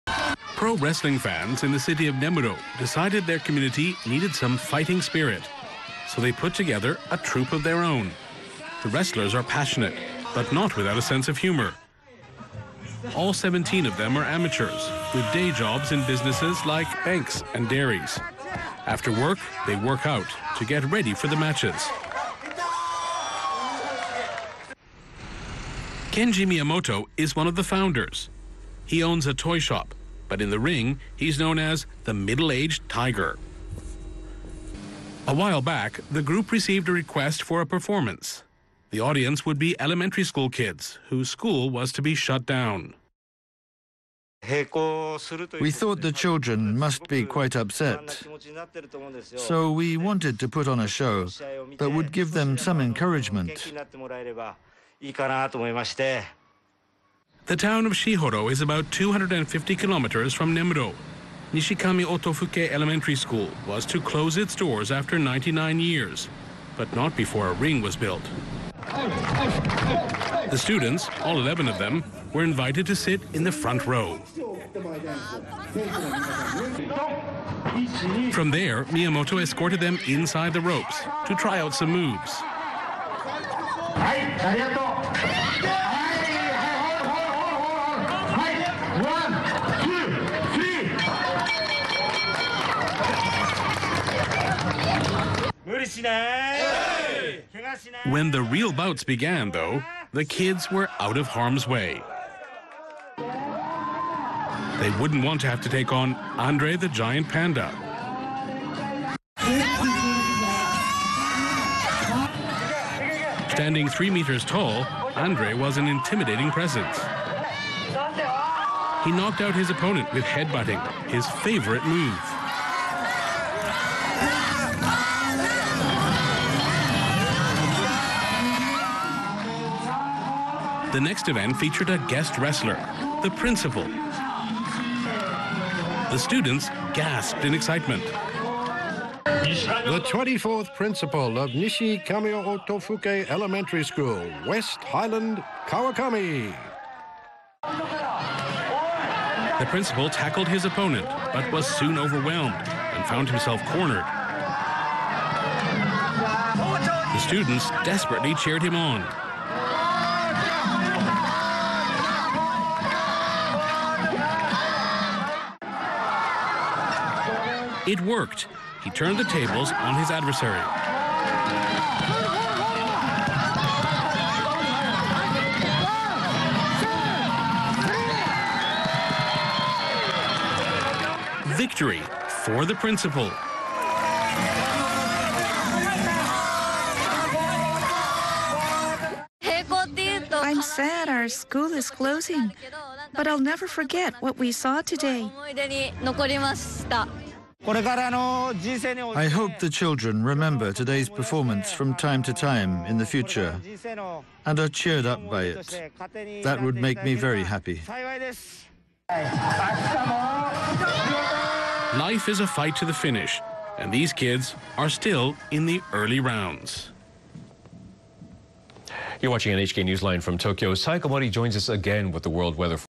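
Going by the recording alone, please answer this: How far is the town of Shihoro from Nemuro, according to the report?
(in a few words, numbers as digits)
250 kilometers.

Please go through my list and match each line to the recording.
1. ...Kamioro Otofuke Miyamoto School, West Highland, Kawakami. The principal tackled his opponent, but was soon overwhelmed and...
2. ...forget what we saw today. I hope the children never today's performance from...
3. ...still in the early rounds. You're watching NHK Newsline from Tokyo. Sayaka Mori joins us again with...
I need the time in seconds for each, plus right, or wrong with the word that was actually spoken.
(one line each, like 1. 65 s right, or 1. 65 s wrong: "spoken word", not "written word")
1. 142 s wrong: "Elementary", not "Miyamoto"
2. 193 s wrong: "remember", not "never"
3. 214 s right.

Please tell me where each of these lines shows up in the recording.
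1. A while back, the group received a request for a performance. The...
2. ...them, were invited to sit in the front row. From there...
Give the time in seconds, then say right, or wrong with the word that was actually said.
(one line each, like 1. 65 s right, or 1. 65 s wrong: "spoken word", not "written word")
1. 35 s right
2. 71 s right.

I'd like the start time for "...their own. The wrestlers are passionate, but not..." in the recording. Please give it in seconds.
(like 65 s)
7 s.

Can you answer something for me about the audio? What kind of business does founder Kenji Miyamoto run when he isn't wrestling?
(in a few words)
toy shop.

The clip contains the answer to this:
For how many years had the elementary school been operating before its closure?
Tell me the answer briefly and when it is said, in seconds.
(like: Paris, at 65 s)
99 years, at 65 s.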